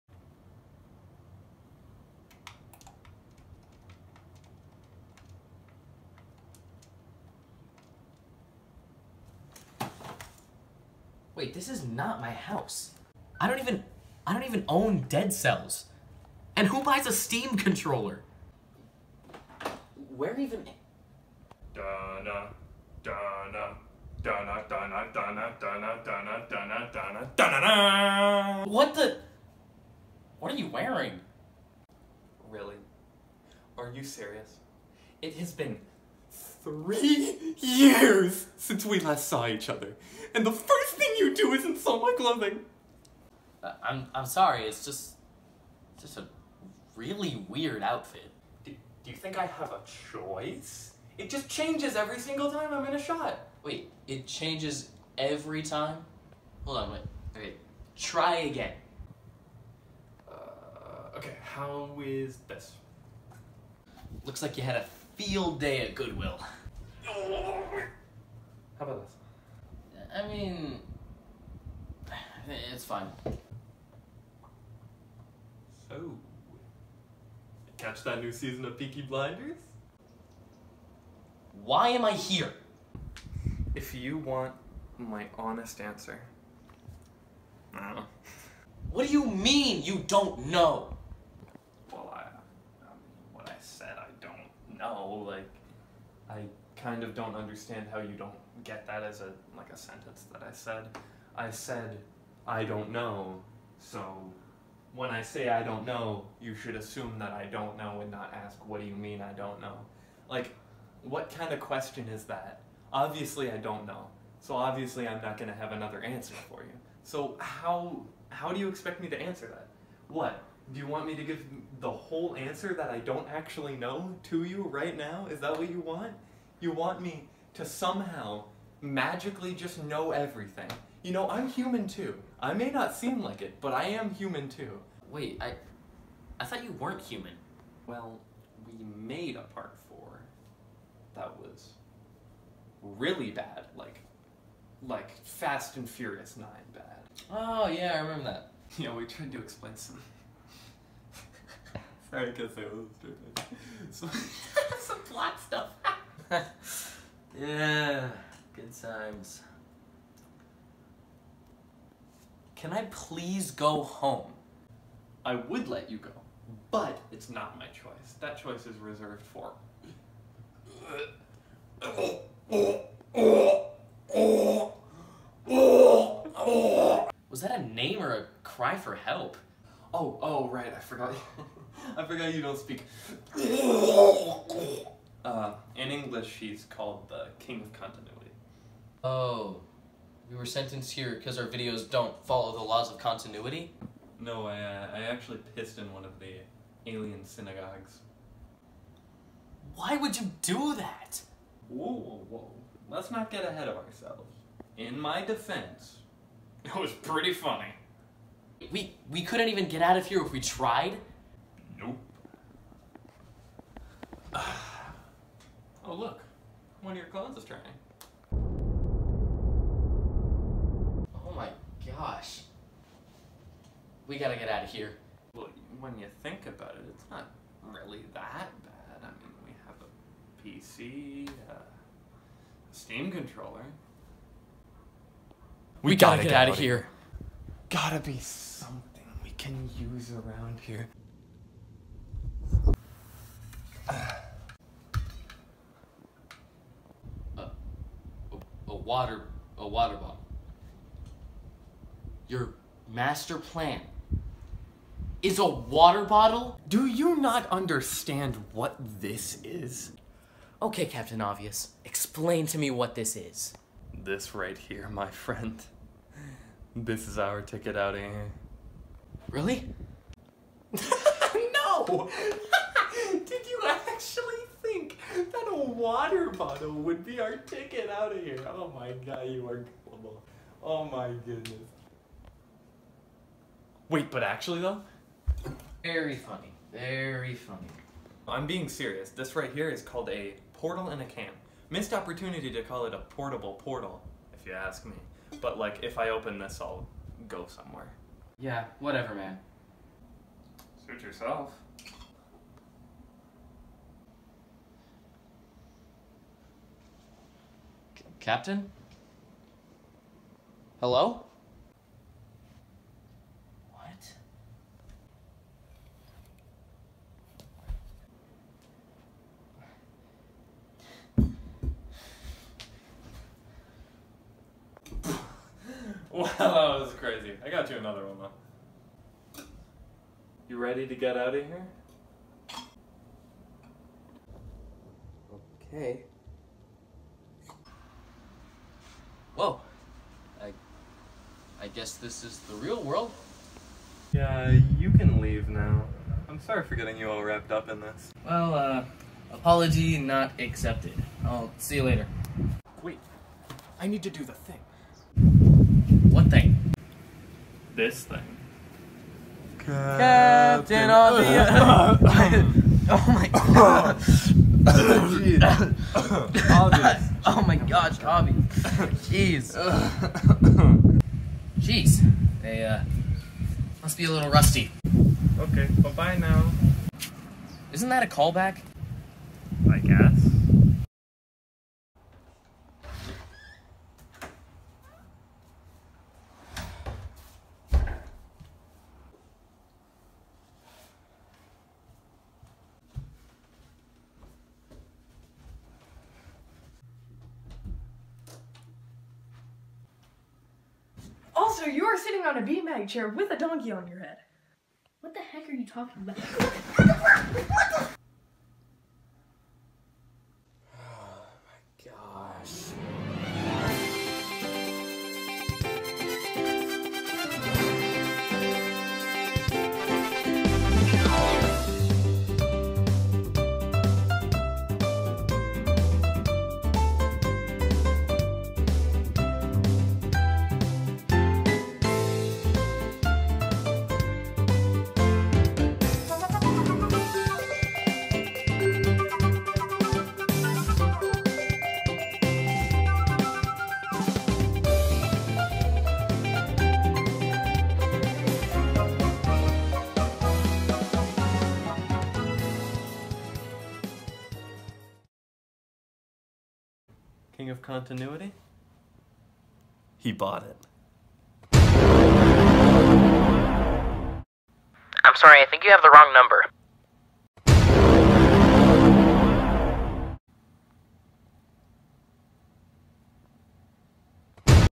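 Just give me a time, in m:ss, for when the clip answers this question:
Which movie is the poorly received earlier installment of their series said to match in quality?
2:25.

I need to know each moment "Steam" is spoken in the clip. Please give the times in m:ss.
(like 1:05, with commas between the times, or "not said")
0:17, 3:52.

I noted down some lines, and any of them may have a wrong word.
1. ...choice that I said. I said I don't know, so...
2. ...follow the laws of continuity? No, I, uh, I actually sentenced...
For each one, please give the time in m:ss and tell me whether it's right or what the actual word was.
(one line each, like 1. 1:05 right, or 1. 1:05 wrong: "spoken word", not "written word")
1. 1:39 wrong: "sentence", not "choice"
2. 3:12 wrong: "pissed", not "sentenced".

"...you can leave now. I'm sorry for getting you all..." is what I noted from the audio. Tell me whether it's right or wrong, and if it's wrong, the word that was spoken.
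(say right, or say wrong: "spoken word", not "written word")
right.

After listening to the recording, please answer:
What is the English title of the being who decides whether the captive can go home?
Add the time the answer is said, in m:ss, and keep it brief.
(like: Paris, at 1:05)
King of Continuity, at 3:07.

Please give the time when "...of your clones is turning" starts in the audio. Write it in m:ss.
3:36.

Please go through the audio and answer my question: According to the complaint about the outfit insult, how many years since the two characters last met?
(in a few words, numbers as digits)
3.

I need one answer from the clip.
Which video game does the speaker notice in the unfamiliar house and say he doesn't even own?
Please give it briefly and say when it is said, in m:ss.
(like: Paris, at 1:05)
Dead Cells, at 0:15.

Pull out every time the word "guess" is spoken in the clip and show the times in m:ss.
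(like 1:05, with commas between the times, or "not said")
2:32, 5:41.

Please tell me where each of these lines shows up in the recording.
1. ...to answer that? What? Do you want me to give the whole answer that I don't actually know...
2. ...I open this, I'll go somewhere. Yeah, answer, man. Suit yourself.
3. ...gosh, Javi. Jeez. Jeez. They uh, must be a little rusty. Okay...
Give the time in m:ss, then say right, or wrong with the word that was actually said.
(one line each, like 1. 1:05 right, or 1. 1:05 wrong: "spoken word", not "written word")
1. 1:59 right
2. 4:55 wrong: "whatever", not "answer"
3. 6:07 right.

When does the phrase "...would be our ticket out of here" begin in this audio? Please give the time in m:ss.
4:36.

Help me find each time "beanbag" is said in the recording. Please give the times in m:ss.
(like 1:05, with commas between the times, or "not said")
6:42.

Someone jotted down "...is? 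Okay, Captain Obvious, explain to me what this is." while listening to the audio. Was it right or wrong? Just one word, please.
right.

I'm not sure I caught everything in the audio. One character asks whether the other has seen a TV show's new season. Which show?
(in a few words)
Peaky Blinders.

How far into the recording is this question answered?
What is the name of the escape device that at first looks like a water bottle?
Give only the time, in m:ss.
4:50.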